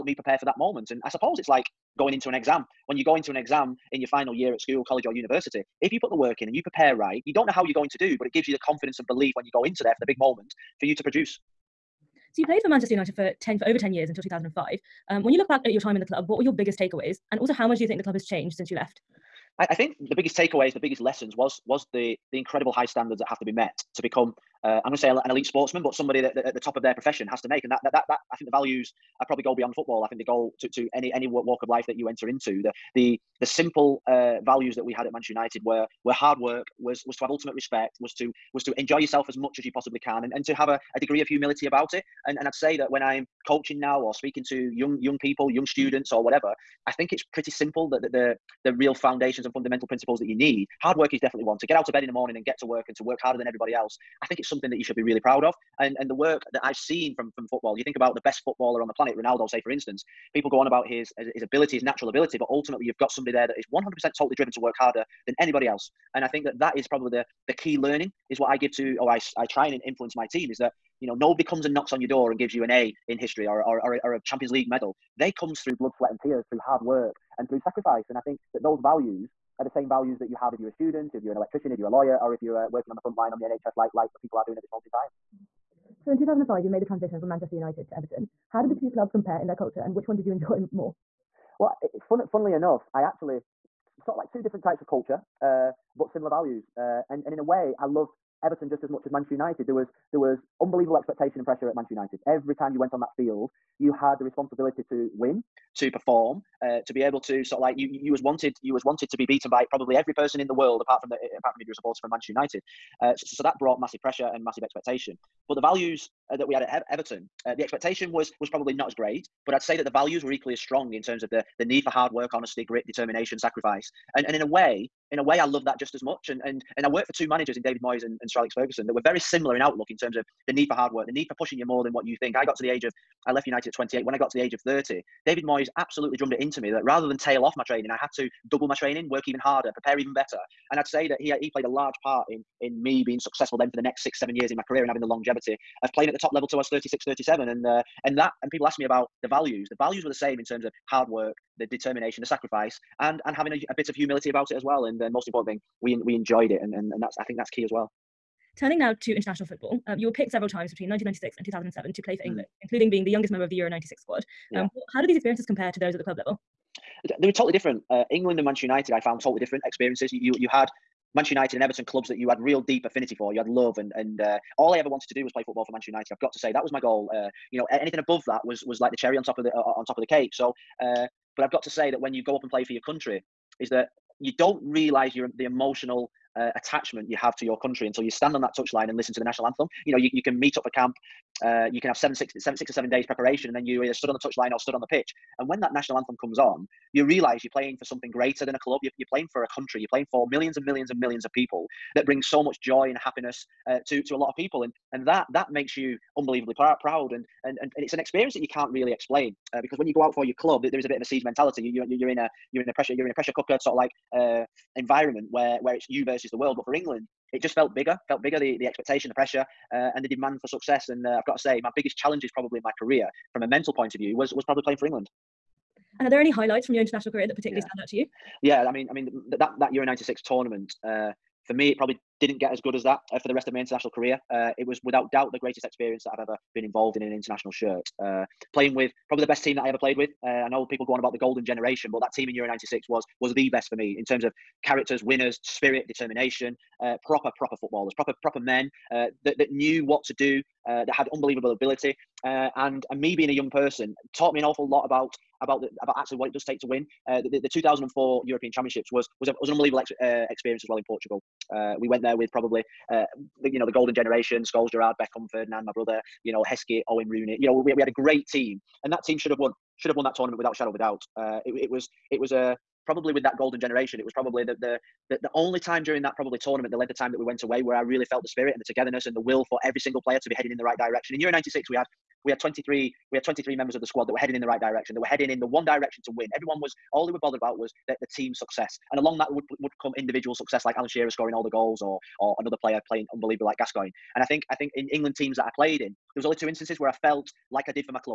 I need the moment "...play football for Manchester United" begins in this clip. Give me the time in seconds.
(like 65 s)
175 s.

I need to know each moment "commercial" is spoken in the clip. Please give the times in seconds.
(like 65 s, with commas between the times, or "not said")
not said.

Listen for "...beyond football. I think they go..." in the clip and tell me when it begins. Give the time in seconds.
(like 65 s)
29 s.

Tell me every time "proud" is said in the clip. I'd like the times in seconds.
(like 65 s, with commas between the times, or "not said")
55 s, 206 s.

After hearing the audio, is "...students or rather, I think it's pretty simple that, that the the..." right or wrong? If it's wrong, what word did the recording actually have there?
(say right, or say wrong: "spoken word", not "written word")
wrong: "whatever", not "rather".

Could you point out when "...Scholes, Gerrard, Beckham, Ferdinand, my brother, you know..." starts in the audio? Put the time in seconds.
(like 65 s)
264 s.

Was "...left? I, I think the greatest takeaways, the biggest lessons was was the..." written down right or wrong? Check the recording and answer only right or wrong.
wrong.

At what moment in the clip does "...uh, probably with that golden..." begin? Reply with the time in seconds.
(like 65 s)
272 s.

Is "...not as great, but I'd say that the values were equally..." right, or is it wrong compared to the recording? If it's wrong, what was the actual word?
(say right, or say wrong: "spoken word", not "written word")
right.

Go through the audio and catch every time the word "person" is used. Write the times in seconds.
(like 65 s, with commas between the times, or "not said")
110 s, 253 s.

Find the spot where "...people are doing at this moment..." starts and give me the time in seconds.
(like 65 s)
84 s.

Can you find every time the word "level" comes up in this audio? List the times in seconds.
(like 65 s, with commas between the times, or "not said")
146 s, 166 s.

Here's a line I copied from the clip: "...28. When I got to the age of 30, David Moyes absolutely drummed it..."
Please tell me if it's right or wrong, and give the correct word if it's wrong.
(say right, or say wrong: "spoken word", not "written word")
right.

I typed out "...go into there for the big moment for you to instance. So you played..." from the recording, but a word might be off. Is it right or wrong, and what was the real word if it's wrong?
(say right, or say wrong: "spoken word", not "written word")
wrong: "produce", not "instance".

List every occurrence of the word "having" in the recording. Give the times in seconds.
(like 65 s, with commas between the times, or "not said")
144 s, 153 s.